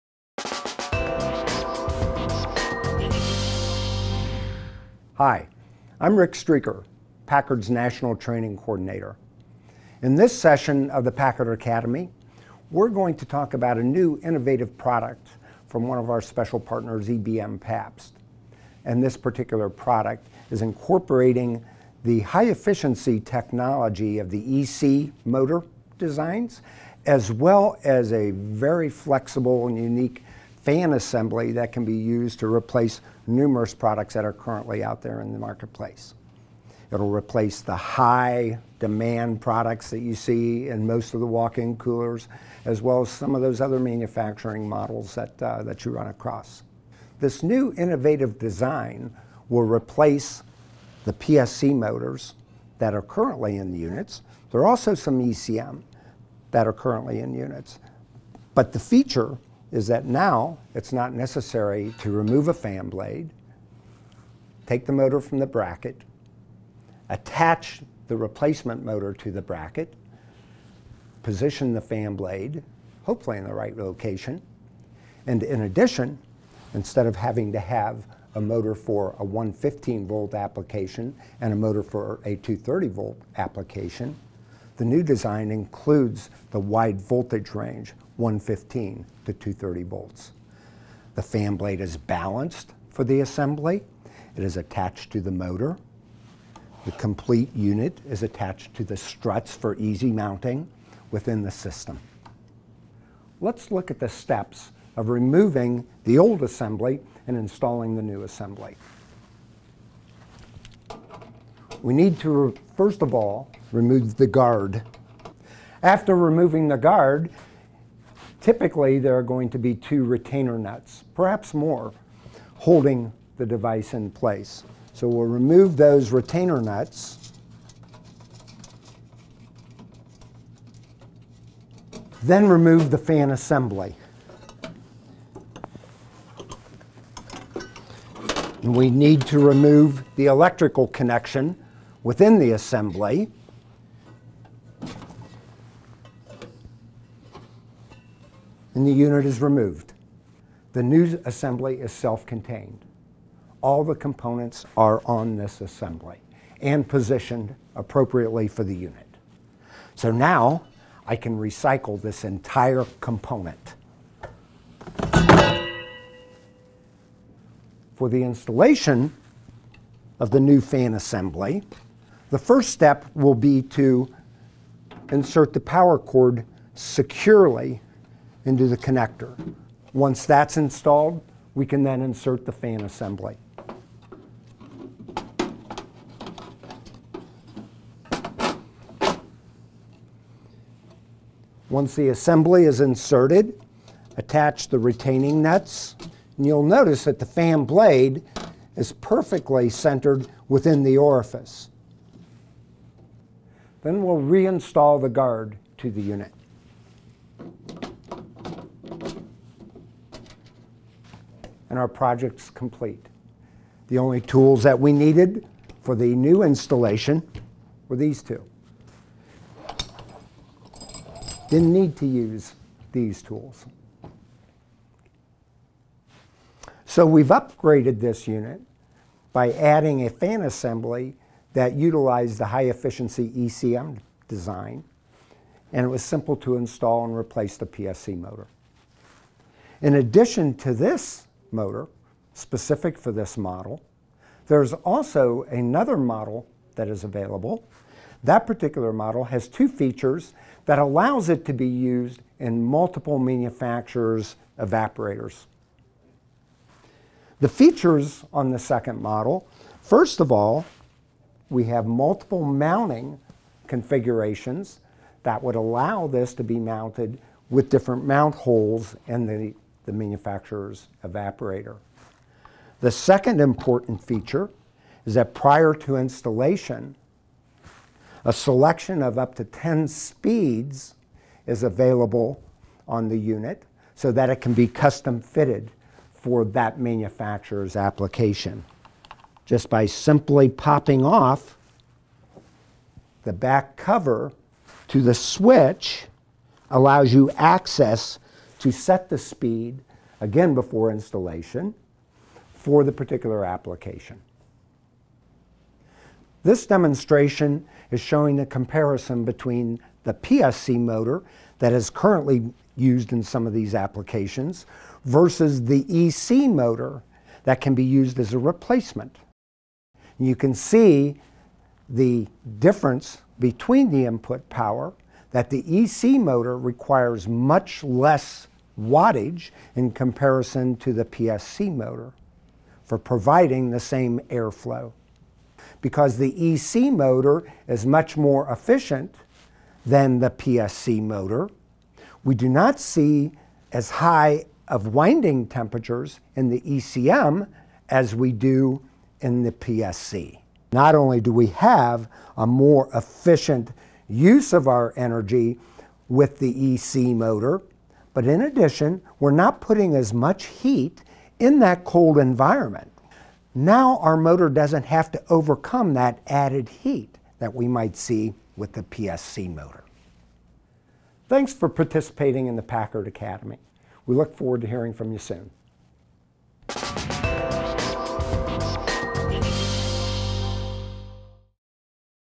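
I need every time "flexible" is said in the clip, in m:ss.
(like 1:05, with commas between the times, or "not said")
0:28.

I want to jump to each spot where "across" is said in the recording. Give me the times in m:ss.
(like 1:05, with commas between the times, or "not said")
0:46.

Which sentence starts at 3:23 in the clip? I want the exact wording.
Then we'll reinstall the guard to the unit.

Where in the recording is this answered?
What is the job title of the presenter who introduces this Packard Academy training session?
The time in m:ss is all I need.
0:07.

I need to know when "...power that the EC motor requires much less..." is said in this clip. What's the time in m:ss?
5:24.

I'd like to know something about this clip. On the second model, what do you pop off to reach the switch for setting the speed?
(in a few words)
the back cover.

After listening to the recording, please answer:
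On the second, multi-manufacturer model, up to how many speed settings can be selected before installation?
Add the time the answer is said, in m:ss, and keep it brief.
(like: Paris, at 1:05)
10, at 4:39.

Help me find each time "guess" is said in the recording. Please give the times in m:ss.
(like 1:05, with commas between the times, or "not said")
not said.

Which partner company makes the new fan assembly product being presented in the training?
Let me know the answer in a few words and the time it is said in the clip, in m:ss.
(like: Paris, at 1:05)
ebm-papst, at 0:17.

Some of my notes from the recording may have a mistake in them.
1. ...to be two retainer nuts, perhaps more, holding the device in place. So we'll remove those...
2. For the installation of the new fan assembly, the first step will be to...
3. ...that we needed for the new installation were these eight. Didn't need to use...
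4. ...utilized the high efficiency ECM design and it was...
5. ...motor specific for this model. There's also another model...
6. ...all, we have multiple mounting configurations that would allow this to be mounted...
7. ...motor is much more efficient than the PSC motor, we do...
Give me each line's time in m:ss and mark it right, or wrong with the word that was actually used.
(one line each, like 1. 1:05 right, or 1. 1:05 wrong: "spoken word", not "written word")
1. 1:59 right
2. 2:47 right
3. 3:34 wrong: "two", not "eight"
4. 3:51 right
5. 4:01 right
6. 4:20 right
7. 5:36 right.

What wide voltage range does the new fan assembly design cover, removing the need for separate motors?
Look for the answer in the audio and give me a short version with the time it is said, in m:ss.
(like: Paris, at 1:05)
115 to 230 volts, at 1:28.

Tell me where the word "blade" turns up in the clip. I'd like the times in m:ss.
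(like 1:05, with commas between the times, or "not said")
1:02, 1:12, 1:31, 3:17.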